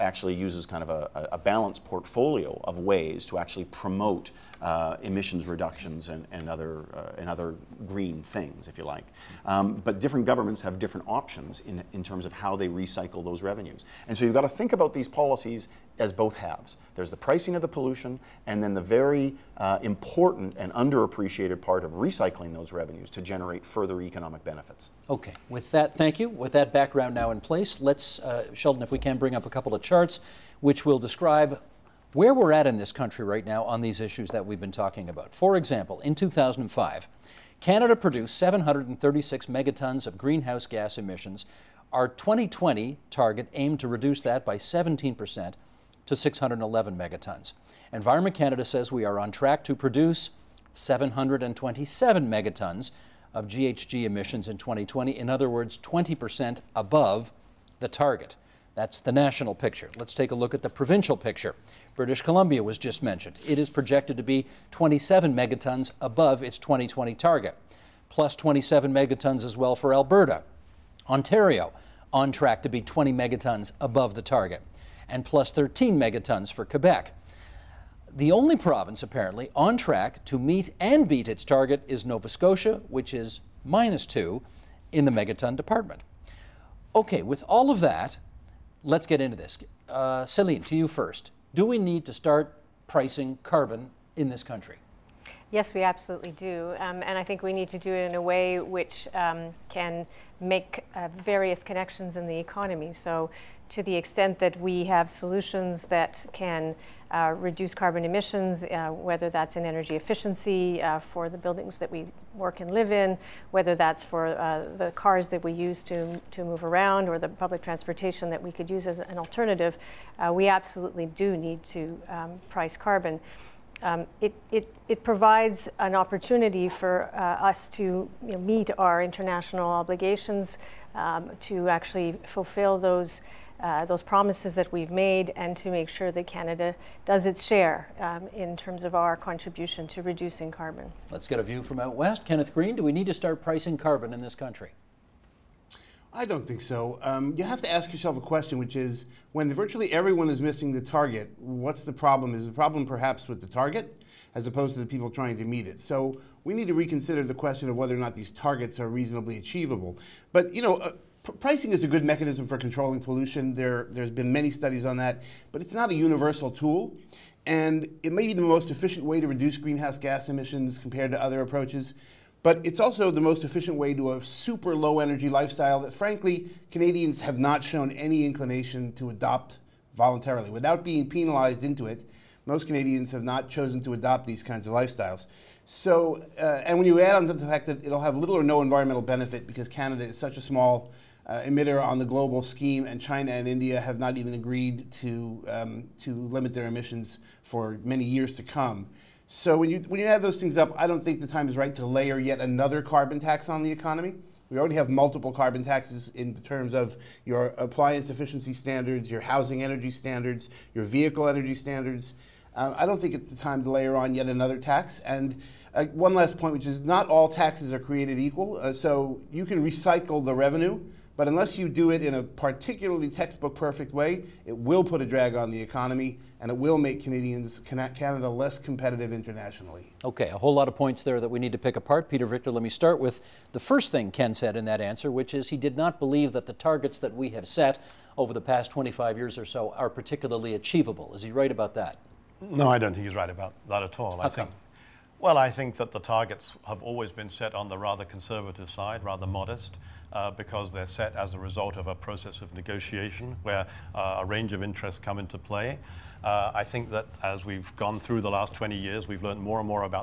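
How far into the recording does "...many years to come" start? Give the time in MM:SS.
03:17.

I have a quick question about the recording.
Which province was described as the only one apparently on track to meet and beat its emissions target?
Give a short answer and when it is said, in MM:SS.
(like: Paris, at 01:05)
Nova Scotia, at 01:22.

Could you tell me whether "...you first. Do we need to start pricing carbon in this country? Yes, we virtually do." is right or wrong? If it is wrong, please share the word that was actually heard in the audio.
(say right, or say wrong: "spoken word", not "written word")
wrong: "absolutely", not "virtually".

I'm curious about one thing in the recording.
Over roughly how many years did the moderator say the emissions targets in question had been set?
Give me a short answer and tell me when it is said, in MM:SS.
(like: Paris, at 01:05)
25 years, at 03:58.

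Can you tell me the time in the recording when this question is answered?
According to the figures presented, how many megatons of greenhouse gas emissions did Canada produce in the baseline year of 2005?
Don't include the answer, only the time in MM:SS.
00:38.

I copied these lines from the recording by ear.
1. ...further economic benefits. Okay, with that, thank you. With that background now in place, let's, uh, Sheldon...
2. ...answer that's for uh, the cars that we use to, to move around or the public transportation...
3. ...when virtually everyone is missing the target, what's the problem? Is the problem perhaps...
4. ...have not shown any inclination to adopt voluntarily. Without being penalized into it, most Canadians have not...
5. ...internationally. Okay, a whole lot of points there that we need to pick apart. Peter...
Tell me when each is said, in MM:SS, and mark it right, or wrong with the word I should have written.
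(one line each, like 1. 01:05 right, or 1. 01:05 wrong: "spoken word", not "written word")
1. 00:23 right
2. 01:53 wrong: "whether", not "answer"
3. 02:29 right
4. 02:57 right
5. 03:49 right.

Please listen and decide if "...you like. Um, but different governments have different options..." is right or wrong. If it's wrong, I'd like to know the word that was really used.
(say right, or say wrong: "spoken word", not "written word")
right.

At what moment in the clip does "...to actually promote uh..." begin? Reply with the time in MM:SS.
00:03.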